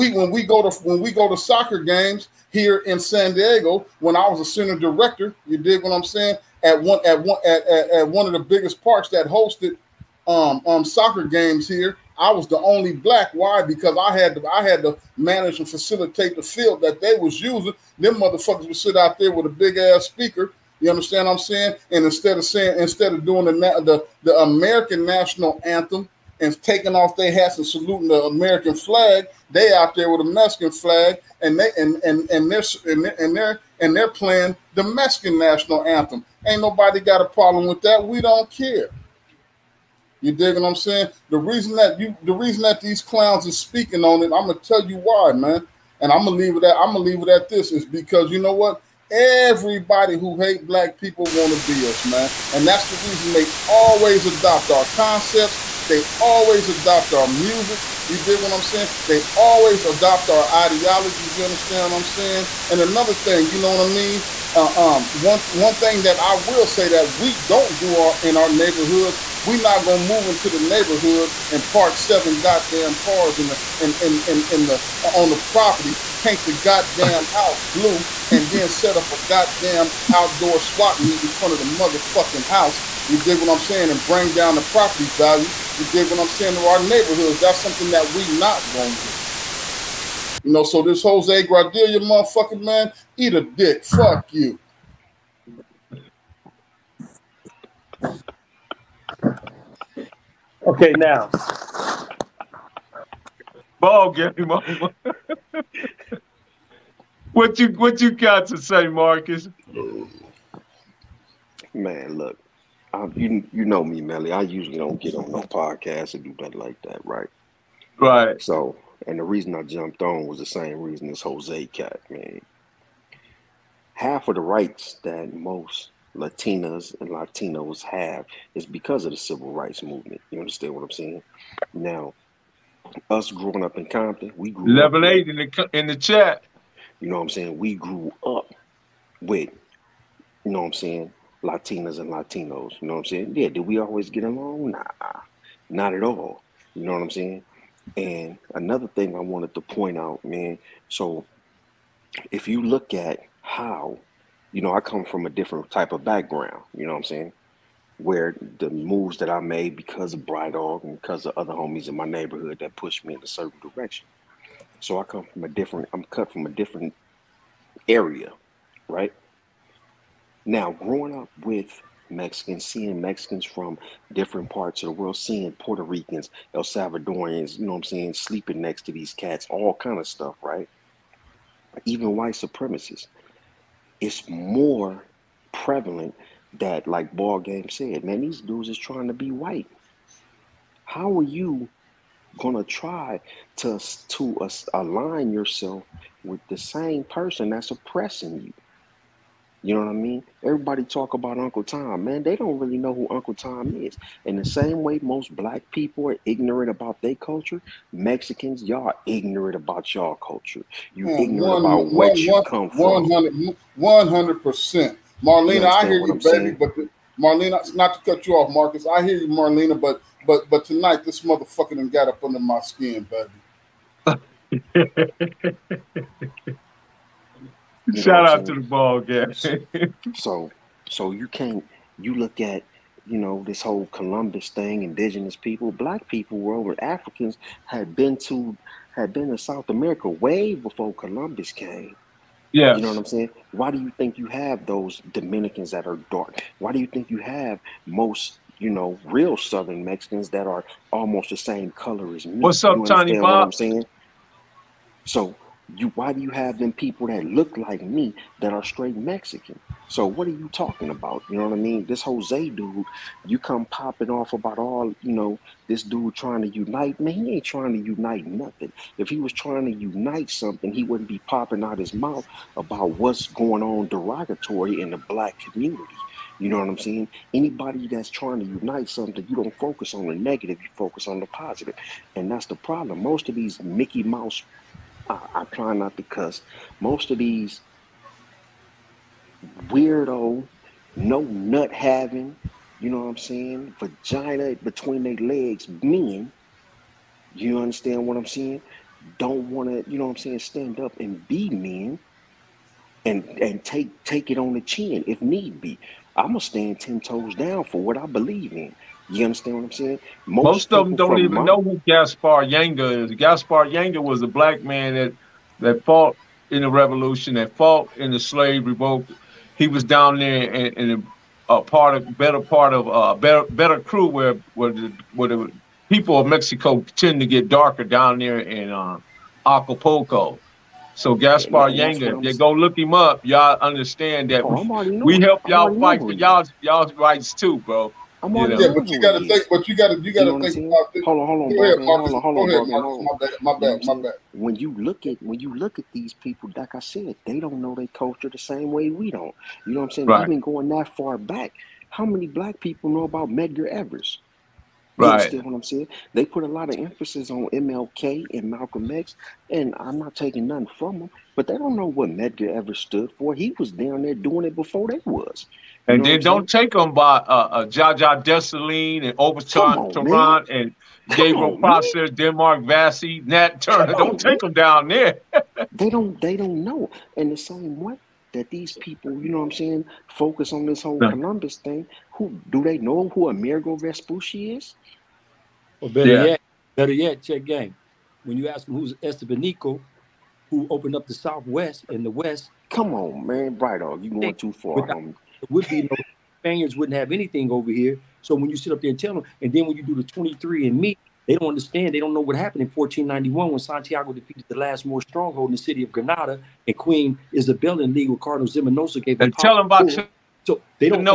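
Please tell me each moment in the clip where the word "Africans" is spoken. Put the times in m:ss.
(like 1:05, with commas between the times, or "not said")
3:56.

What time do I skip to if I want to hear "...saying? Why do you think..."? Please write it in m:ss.
4:03.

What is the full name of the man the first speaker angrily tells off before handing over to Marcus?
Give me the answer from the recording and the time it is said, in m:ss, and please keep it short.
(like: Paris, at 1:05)
Jose Gradilla, at 1:31.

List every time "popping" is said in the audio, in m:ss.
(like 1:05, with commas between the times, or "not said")
4:23, 4:31.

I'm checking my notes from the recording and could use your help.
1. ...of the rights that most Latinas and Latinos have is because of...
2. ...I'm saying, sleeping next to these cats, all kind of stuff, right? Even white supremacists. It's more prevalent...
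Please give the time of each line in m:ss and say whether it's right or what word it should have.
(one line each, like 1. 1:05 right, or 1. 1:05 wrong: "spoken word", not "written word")
1. 2:04 right
2. 2:57 right.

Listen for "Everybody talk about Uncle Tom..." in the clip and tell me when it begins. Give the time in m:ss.
3:20.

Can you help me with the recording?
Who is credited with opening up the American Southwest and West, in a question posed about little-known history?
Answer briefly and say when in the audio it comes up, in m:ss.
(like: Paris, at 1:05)
Estebanico, at 6:28.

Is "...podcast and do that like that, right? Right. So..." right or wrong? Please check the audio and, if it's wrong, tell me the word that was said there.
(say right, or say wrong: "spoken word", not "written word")
right.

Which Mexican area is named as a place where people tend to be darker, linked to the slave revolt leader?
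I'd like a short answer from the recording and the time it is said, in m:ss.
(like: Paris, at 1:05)
Acapulco, at 5:29.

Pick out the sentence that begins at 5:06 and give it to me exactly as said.
I'm gonna stand ten toes down for what I believe in.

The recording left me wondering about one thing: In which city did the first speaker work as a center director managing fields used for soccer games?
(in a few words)
San Diego.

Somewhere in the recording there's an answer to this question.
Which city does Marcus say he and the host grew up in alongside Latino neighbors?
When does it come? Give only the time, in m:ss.
2:13.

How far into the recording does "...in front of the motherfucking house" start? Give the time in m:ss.
1:21.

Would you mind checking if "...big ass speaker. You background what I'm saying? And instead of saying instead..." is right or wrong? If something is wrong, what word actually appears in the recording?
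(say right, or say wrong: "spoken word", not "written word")
wrong: "understand", not "background".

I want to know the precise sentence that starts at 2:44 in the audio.
So I come from a different, I'm cut from a different area, right?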